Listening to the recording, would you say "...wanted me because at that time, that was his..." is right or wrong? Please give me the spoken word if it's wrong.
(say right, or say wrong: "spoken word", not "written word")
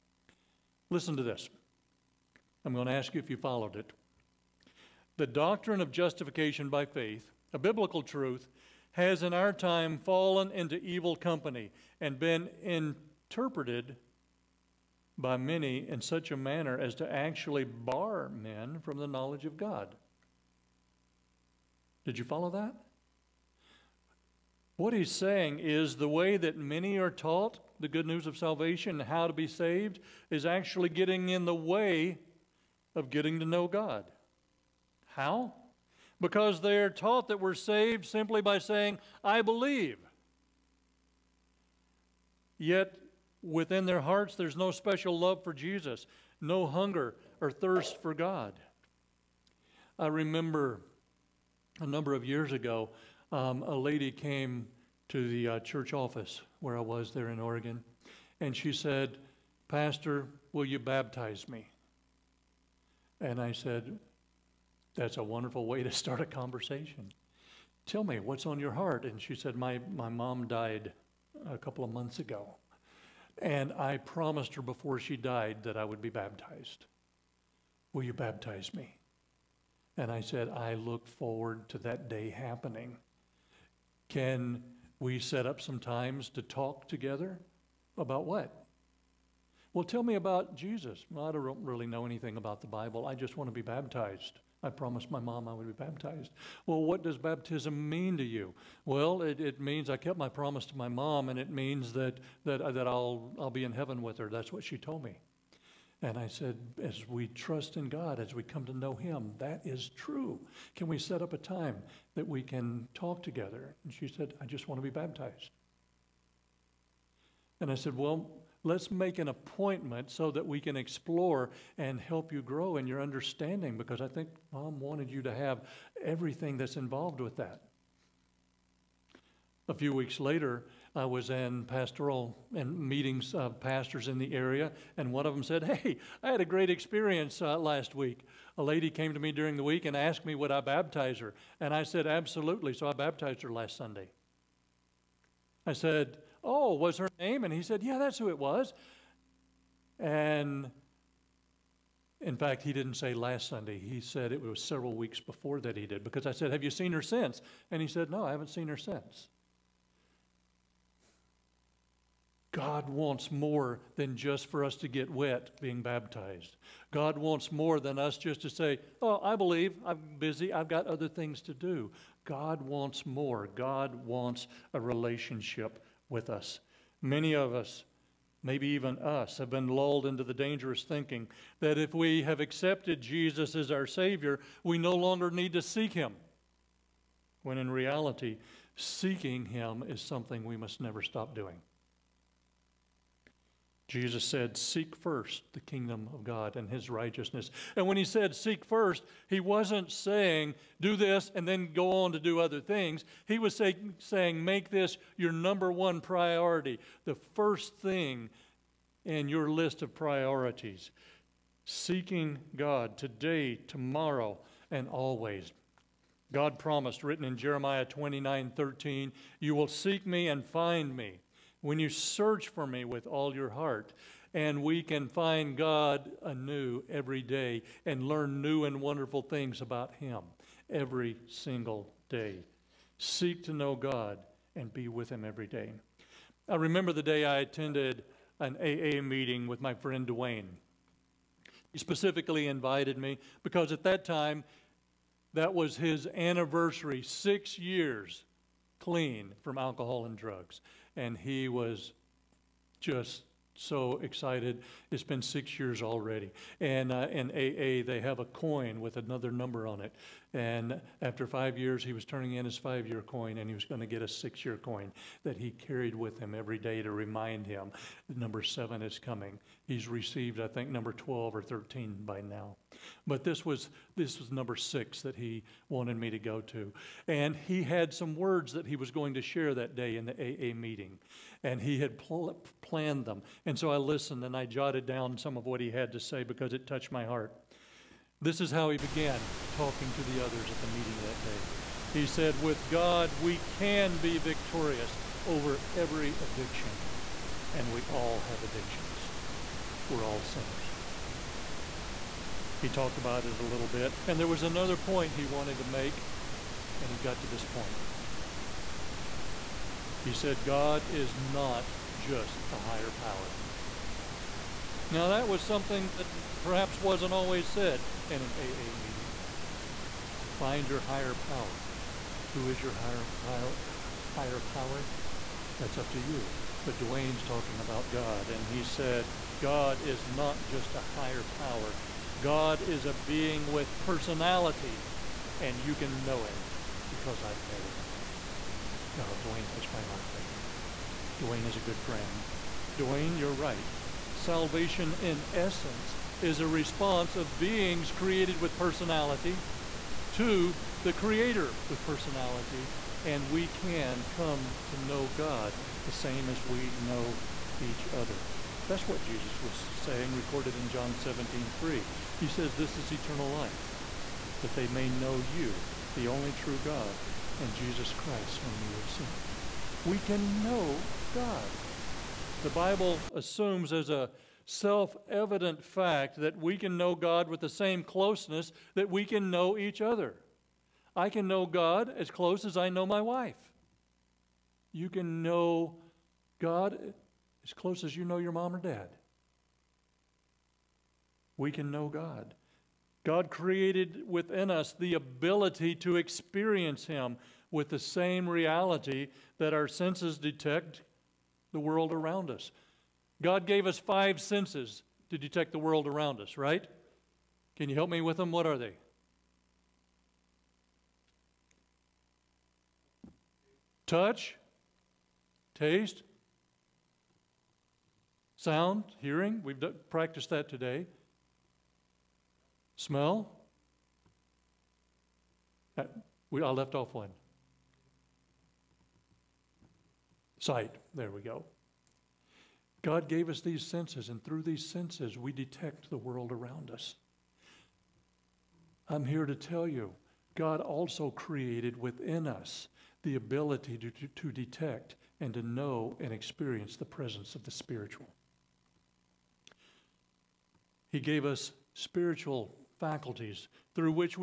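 wrong: "invited", not "wanted".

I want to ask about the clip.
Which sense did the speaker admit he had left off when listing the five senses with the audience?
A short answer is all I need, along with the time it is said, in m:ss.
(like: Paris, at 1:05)
Sight, at 7:10.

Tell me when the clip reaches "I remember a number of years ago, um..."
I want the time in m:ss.
0:49.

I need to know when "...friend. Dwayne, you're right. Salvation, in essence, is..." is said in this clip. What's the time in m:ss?
5:41.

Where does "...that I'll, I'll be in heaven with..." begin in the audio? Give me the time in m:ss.
1:42.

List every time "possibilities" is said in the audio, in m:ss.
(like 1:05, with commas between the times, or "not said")
not said.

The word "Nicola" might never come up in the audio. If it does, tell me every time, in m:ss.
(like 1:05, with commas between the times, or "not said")
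not said.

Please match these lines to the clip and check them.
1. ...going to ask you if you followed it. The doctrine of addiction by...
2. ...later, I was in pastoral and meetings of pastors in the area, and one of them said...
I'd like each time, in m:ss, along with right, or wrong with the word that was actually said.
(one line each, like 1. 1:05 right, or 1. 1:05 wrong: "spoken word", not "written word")
1. 0:02 wrong: "justification", not "addiction"
2. 2:10 right.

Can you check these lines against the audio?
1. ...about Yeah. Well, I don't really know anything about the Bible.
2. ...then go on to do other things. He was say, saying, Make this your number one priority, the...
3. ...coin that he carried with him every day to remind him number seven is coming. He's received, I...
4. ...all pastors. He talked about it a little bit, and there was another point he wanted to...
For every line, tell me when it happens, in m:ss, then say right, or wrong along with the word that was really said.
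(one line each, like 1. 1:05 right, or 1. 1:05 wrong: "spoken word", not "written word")
1. 1:30 wrong: "Jesus", not "Yeah"
2. 3:21 right
3. 4:24 right
4. 5:00 wrong: "sinners", not "pastors".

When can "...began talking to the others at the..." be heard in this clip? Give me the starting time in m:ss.
4:48.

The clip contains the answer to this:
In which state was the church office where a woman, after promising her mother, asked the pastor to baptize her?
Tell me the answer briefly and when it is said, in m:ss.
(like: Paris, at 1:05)
Oregon, at 0:57.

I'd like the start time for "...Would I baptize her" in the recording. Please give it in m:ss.
2:20.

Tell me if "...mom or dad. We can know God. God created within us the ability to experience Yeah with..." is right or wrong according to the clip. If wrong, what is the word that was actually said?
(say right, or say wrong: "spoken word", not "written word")
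wrong: "Him", not "Yeah".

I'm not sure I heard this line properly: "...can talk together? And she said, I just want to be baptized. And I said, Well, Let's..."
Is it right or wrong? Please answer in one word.
right.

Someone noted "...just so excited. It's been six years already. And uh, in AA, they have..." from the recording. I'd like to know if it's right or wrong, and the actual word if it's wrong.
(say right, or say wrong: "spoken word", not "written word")
right.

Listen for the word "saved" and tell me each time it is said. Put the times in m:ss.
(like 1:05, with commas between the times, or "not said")
0:29, 0:37.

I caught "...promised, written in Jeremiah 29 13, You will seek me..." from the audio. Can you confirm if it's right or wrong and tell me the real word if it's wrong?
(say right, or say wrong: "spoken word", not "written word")
right.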